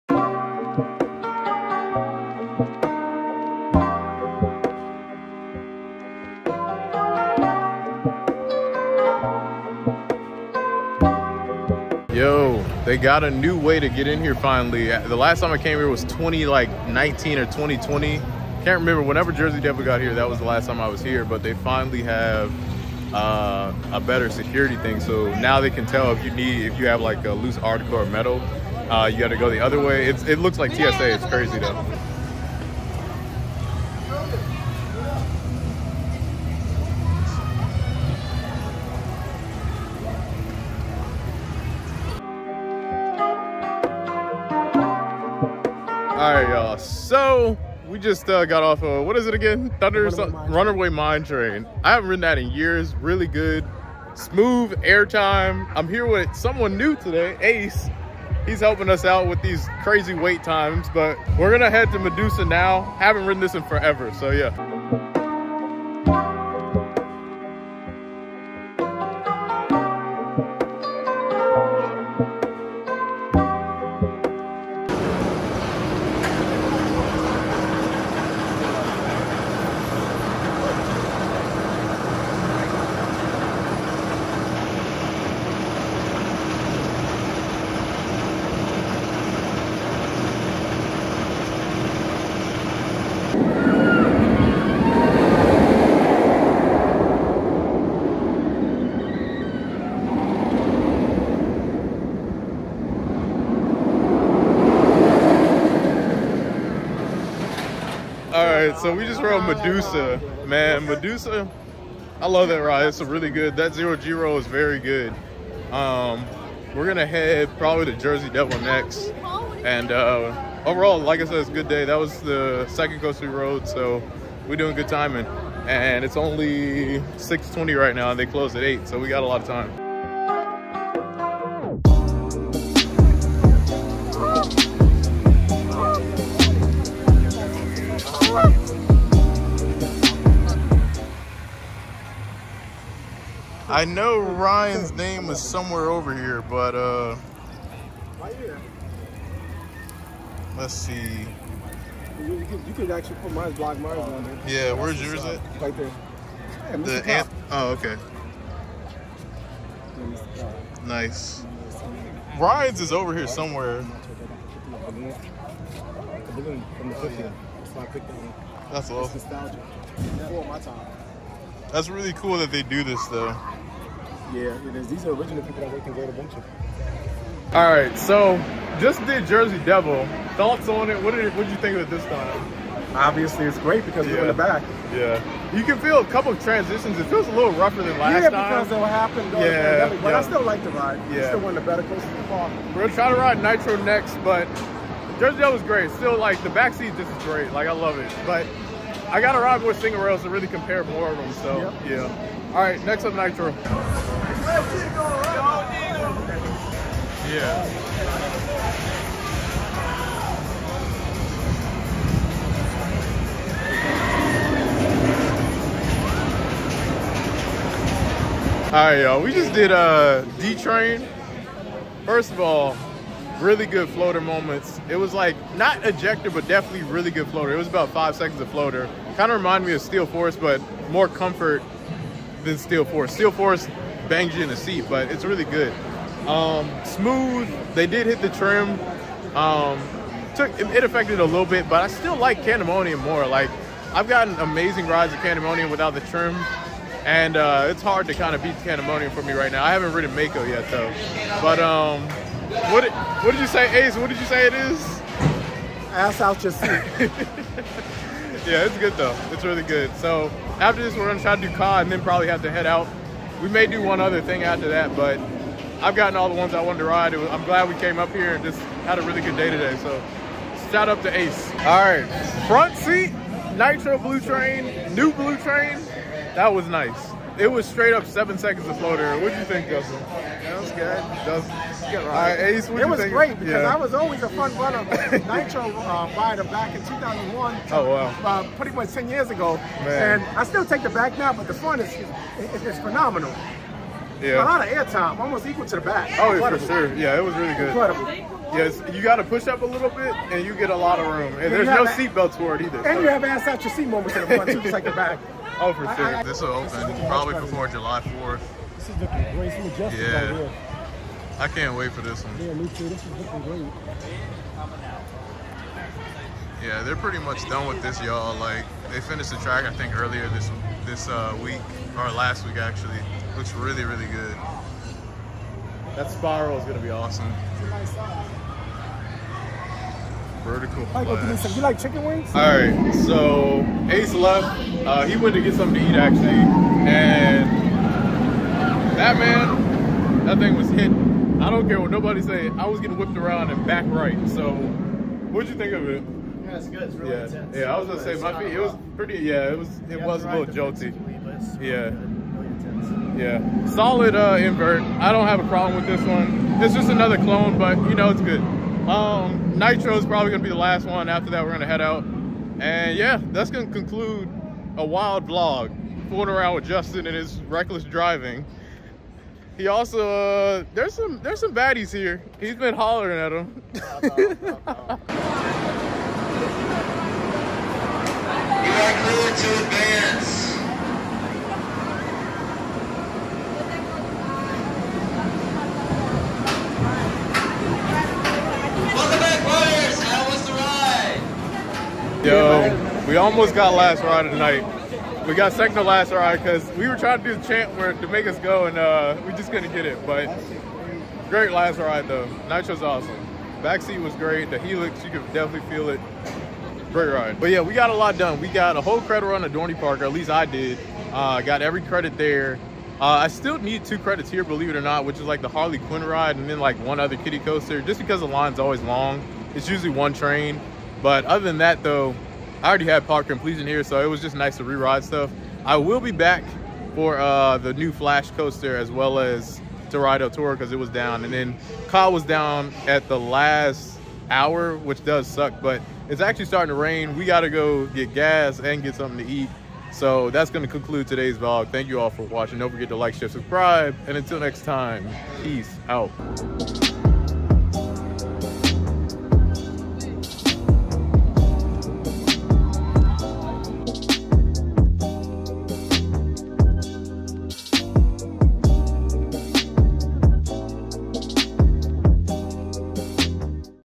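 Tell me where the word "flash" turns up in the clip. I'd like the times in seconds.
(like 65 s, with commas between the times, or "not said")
330 s, 427 s.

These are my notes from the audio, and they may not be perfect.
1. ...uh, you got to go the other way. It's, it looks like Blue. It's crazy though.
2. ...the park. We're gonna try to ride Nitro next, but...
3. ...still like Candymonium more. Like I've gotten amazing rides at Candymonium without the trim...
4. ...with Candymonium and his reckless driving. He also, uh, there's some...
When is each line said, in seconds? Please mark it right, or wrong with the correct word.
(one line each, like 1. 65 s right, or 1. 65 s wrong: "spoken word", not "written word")
1. 28 s wrong: "TSA", not "Blue"
2. 192 s right
3. 241 s right
4. 366 s wrong: "Justin", not "Candymonium".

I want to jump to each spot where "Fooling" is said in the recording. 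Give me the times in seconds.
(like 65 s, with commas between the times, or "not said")
366 s.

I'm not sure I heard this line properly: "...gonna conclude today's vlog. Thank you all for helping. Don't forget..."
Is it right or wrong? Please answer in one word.
wrong.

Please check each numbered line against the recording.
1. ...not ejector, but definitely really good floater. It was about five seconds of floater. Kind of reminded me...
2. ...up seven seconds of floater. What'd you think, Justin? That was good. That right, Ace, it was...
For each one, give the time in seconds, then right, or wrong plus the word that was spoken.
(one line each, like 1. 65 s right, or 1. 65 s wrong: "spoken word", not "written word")
1. 225 s right
2. 277 s right.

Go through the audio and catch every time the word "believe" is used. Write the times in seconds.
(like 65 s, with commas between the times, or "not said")
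414 s.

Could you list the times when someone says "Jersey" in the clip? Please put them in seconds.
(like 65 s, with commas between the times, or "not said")
19 s, 117 s, 179 s, 195 s.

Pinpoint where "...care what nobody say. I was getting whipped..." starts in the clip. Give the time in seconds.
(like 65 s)
341 s.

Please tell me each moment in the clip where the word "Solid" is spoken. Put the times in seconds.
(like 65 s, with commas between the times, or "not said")
353 s.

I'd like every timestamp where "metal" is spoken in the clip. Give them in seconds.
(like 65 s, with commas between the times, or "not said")
28 s.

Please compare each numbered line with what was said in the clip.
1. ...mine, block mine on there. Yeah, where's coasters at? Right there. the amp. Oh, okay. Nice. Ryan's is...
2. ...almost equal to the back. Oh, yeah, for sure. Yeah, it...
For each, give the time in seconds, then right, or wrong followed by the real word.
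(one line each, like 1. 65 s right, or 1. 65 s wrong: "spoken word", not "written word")
1. 153 s wrong: "yours", not "coasters"
2. 295 s right.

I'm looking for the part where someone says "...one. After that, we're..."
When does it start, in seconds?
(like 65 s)
360 s.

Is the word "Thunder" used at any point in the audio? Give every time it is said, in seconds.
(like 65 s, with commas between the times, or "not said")
49 s.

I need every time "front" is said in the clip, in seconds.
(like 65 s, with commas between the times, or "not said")
272 s, 291 s, 304 s.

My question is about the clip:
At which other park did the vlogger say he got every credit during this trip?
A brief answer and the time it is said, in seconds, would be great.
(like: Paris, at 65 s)
Dorney Park, at 409 s.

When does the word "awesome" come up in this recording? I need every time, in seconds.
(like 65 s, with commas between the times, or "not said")
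168 s, 326 s, 402 s.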